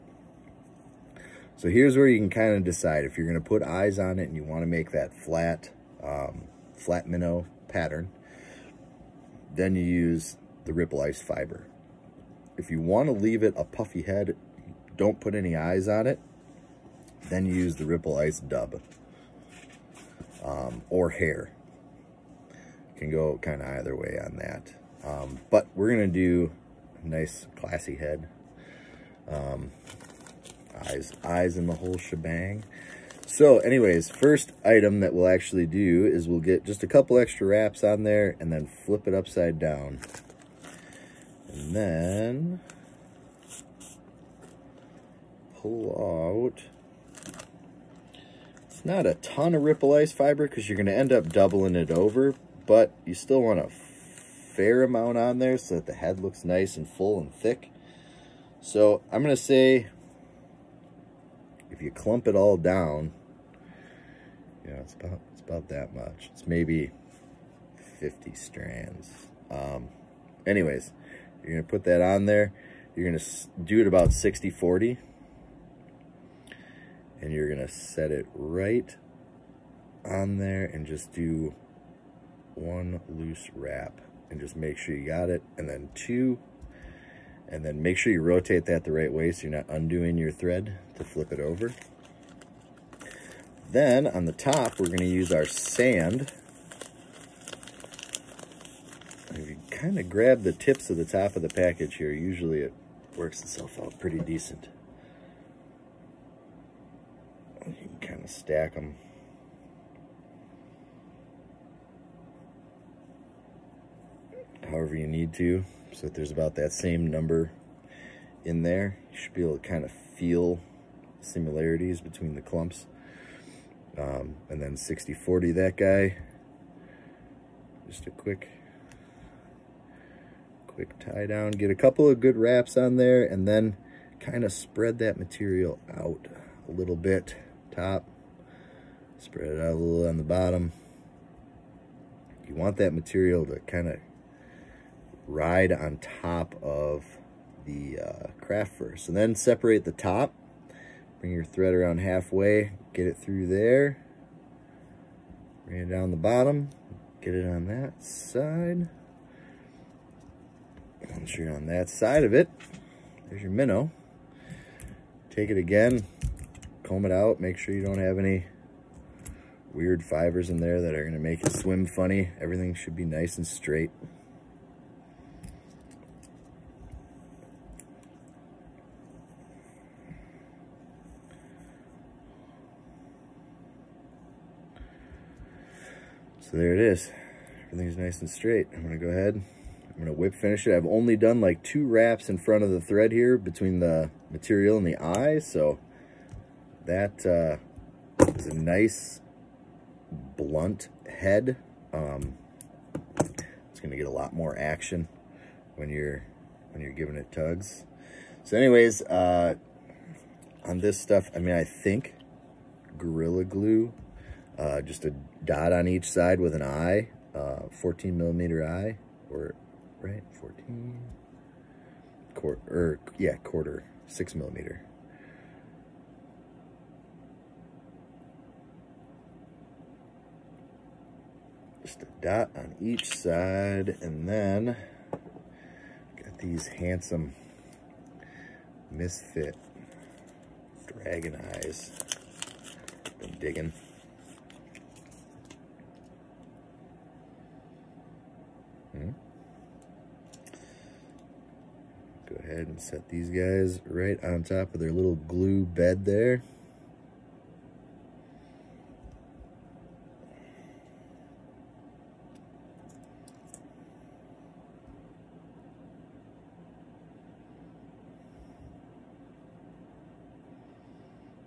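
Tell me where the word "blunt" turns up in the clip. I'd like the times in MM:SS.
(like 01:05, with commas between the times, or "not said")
03:20.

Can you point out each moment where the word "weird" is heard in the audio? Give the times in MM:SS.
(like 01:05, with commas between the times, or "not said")
02:49.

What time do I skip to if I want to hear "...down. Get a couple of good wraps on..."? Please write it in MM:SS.
02:11.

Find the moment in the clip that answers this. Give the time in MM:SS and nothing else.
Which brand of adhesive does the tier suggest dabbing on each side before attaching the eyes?
03:32.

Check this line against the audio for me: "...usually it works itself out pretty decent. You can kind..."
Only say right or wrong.
right.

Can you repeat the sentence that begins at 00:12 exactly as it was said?
If you want to leave it a puffy head, don't put any eyes on it.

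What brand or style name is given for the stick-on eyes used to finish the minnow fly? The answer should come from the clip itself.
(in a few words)
misfit dragon eyes.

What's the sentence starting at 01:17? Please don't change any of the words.
And you're going to set it right on there and just do one loose wrap and just make sure you got it.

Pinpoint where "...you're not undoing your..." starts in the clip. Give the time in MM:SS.
01:29.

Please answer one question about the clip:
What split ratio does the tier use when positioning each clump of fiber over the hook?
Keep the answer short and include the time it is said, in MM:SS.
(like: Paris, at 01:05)
60/40, at 01:14.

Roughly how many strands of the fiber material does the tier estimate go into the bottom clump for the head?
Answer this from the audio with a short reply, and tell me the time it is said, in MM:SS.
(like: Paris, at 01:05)
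50, at 01:08.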